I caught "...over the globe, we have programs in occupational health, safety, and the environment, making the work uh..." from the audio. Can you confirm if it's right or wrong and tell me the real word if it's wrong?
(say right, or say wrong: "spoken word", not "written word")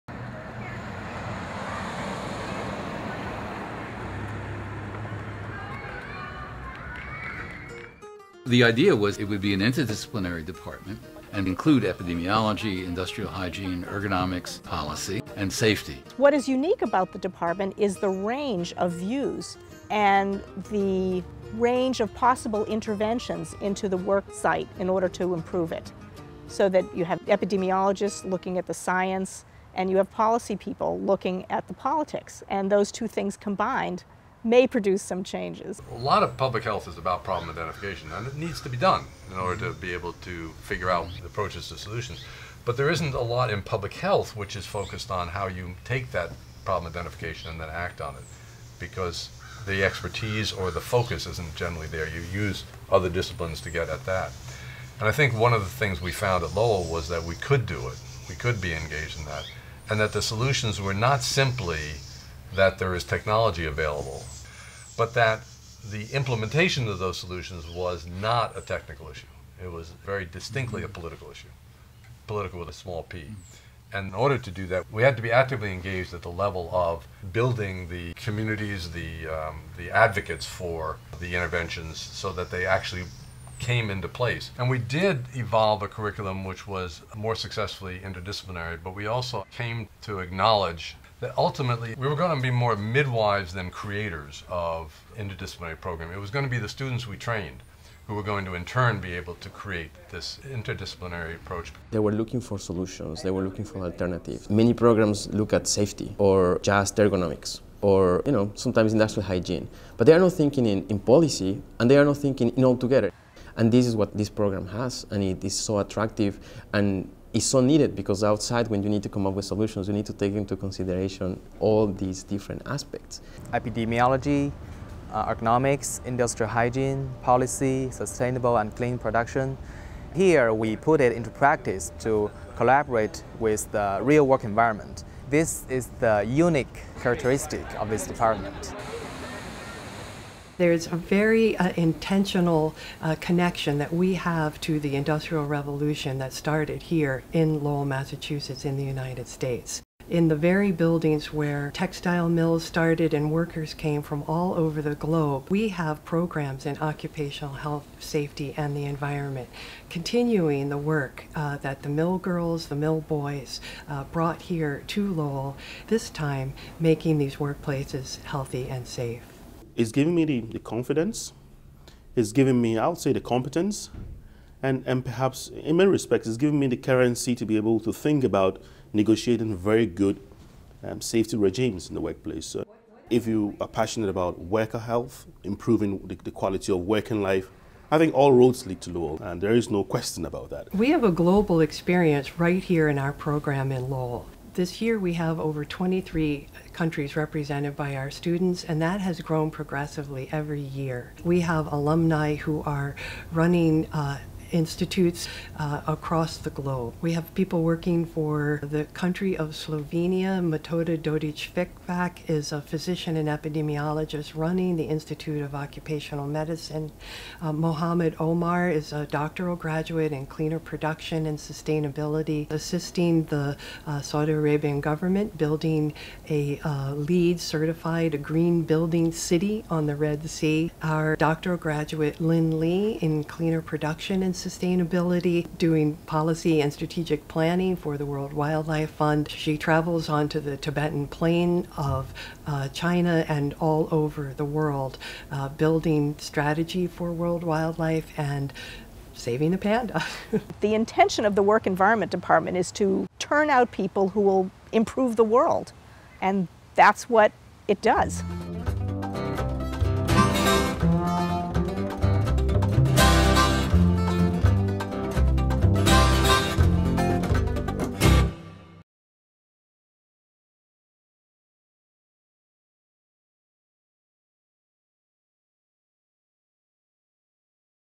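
wrong: "continuing", not "making".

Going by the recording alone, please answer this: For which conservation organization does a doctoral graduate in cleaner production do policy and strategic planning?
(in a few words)
World Wildlife Fund.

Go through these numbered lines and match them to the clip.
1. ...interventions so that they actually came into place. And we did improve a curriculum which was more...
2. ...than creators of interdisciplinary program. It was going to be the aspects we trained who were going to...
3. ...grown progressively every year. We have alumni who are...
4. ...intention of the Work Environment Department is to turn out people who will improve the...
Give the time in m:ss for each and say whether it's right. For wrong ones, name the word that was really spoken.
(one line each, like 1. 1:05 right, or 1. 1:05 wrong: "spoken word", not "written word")
1. 1:21 wrong: "evolve", not "improve"
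2. 1:33 wrong: "students", not "aspects"
3. 3:19 right
4. 4:10 right.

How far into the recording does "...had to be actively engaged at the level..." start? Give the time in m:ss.
1:15.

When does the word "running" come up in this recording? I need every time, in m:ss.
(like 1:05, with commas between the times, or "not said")
3:23, 3:34.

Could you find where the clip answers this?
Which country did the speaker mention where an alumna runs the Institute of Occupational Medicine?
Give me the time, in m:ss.
3:29.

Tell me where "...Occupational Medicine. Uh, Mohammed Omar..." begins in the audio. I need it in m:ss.
3:35.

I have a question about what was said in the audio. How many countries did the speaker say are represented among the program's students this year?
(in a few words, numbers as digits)
23.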